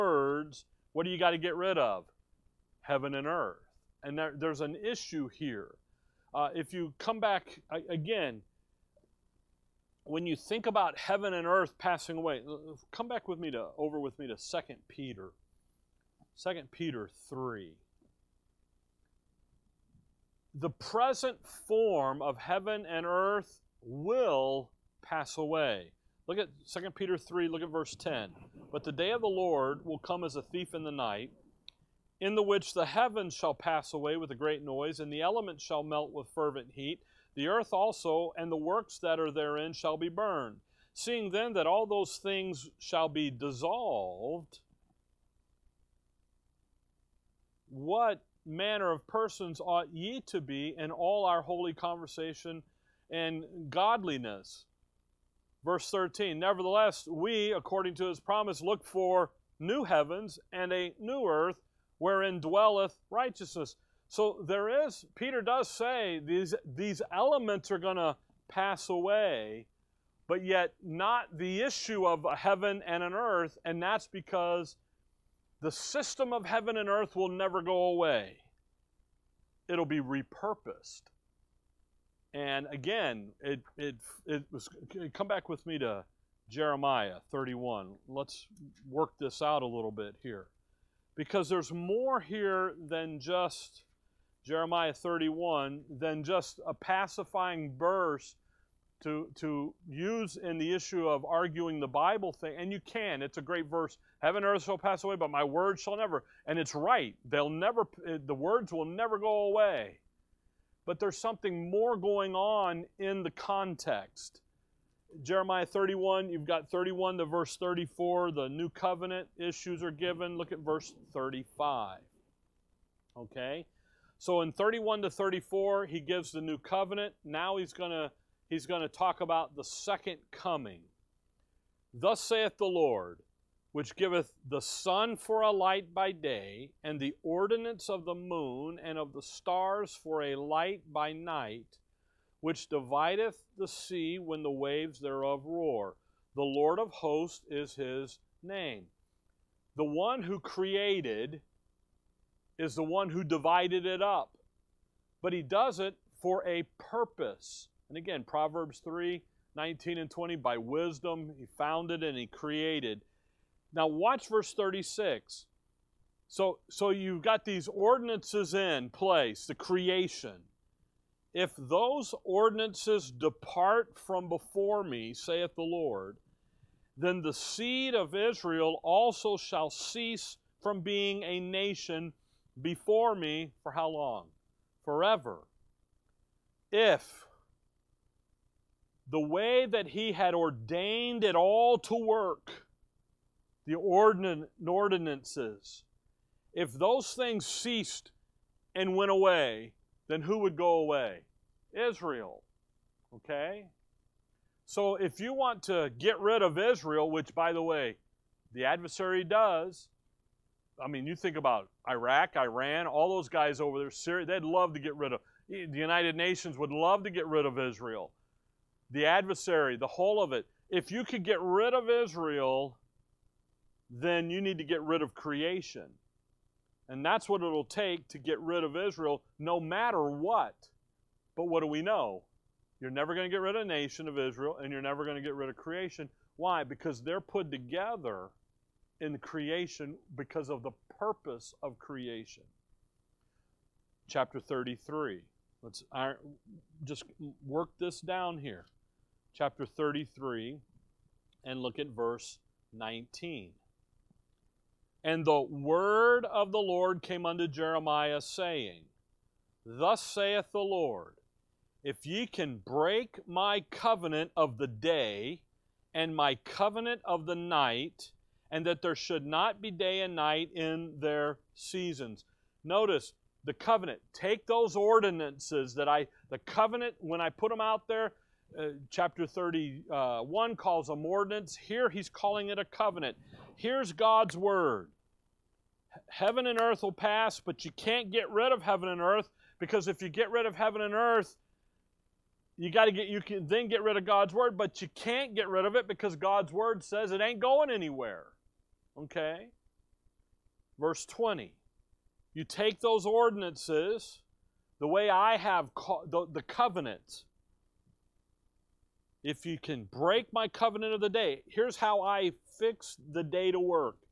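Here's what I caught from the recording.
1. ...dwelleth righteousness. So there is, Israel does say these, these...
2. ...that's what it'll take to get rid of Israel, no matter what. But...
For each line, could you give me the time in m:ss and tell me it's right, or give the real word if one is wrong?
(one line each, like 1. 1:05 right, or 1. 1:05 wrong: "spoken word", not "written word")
1. 1:02 wrong: "Peter", not "Israel"
2. 3:47 right.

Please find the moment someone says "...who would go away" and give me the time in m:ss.
3:20.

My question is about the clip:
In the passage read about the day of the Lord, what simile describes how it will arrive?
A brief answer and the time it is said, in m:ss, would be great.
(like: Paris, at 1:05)
As a thief in the night, at 0:30.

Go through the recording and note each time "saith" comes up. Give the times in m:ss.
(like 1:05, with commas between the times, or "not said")
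2:12, 2:55, 4:20.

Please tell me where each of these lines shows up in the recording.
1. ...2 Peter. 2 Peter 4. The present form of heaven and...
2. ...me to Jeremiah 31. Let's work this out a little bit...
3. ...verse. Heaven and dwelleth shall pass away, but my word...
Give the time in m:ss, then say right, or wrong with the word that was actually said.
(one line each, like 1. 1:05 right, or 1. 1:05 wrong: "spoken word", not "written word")
1. 0:14 wrong: "3", not "4"
2. 1:25 right
3. 1:43 wrong: "earth", not "dwelleth".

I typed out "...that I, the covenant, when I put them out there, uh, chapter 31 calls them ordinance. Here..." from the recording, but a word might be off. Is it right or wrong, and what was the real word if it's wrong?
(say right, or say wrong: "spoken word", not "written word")
right.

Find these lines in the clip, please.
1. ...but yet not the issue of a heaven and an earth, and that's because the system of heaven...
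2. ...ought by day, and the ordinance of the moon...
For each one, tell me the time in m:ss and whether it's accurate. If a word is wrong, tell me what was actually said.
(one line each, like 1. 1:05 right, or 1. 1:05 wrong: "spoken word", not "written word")
1. 1:10 right
2. 2:15 wrong: "light", not "ought".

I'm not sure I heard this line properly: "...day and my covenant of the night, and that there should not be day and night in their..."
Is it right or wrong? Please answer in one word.
right.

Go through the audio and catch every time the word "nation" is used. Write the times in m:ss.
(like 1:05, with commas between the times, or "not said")
3:01, 3:36, 3:53.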